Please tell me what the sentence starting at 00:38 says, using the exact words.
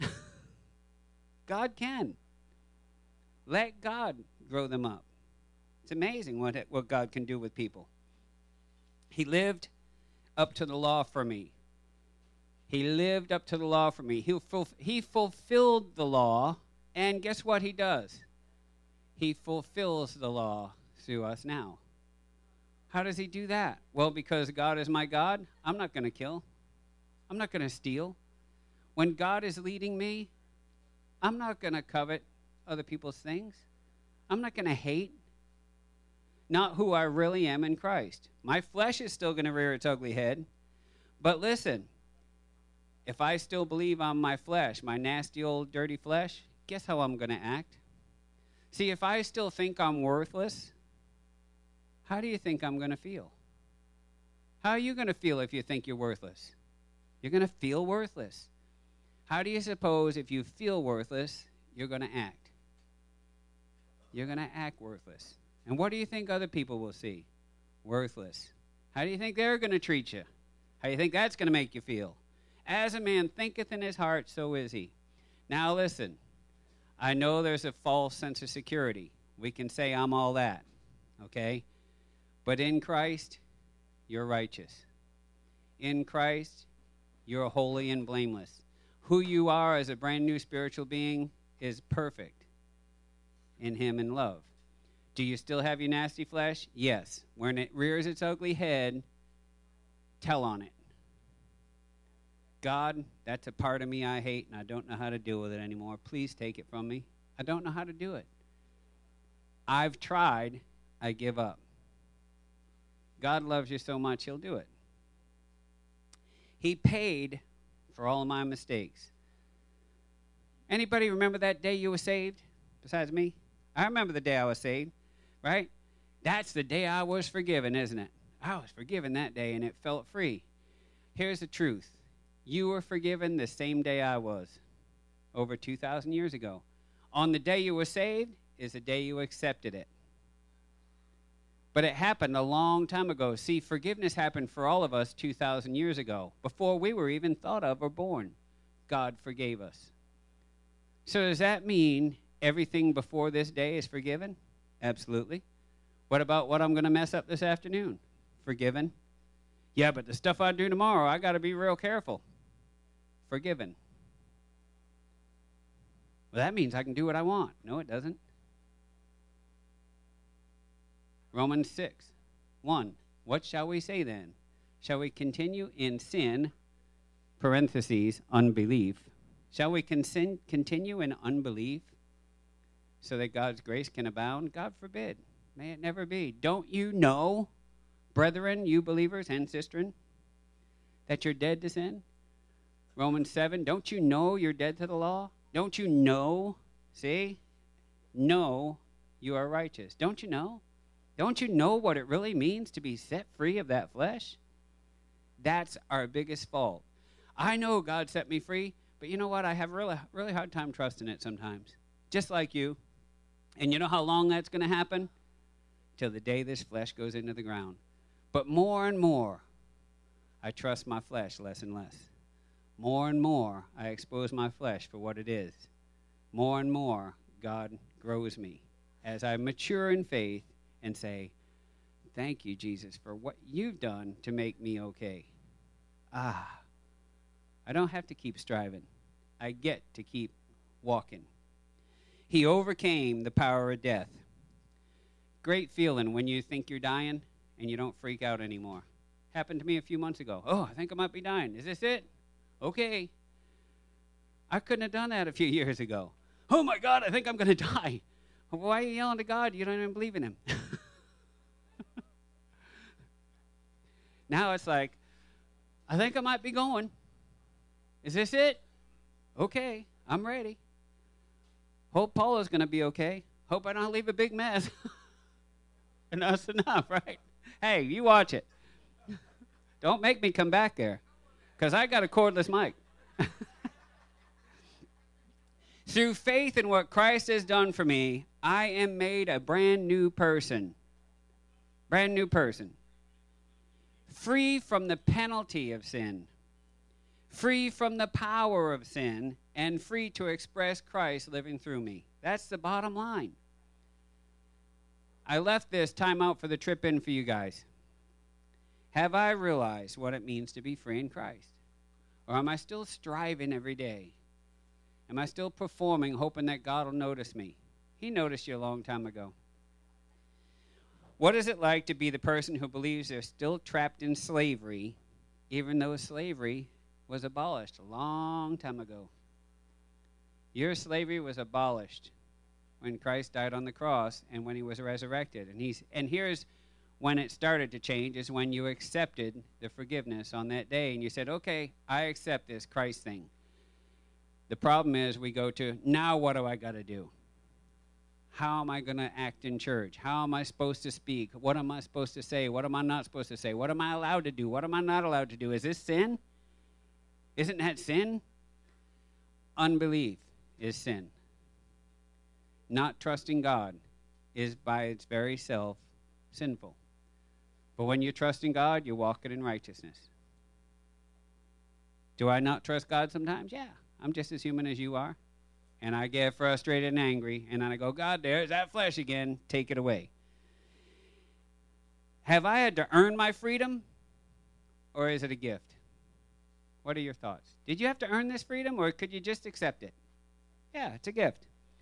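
My flesh is still going to rear its ugly head.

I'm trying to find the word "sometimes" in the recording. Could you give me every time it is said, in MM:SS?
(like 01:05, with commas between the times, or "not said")
03:31, 06:13.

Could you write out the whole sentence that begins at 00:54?
How are you going to feel if you think you're worthless?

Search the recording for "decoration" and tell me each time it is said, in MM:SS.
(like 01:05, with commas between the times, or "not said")
not said.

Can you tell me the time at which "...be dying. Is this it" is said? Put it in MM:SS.
04:11.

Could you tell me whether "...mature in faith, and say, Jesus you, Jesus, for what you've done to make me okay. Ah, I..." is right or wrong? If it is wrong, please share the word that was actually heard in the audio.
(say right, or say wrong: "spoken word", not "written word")
wrong: "Thank", not "Jesus".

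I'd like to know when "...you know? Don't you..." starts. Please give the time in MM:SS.
03:20.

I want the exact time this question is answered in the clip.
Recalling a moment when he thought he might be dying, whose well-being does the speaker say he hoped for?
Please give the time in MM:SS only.
04:32.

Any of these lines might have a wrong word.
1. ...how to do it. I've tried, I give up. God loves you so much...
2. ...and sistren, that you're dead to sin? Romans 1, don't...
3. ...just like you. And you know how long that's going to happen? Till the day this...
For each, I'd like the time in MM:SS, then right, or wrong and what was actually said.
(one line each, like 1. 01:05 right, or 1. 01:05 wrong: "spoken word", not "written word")
1. 01:47 right
2. 03:09 wrong: "7", not "1"
3. 03:32 right.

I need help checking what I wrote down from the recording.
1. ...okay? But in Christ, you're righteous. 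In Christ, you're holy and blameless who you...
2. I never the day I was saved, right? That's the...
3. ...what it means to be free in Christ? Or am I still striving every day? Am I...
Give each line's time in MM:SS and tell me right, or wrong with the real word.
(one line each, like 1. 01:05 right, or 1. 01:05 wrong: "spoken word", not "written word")
1. 01:21 right
2. 02:03 wrong: "remember", not "never"
3. 05:09 right.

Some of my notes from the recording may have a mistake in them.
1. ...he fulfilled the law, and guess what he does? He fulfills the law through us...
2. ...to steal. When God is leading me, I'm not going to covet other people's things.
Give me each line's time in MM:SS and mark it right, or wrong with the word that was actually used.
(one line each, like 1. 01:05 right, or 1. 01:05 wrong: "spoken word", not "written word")
1. 00:14 right
2. 00:27 right.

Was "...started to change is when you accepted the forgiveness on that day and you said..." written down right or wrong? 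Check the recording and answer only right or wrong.
right.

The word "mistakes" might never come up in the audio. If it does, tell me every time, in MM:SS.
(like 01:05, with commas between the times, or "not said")
01:58.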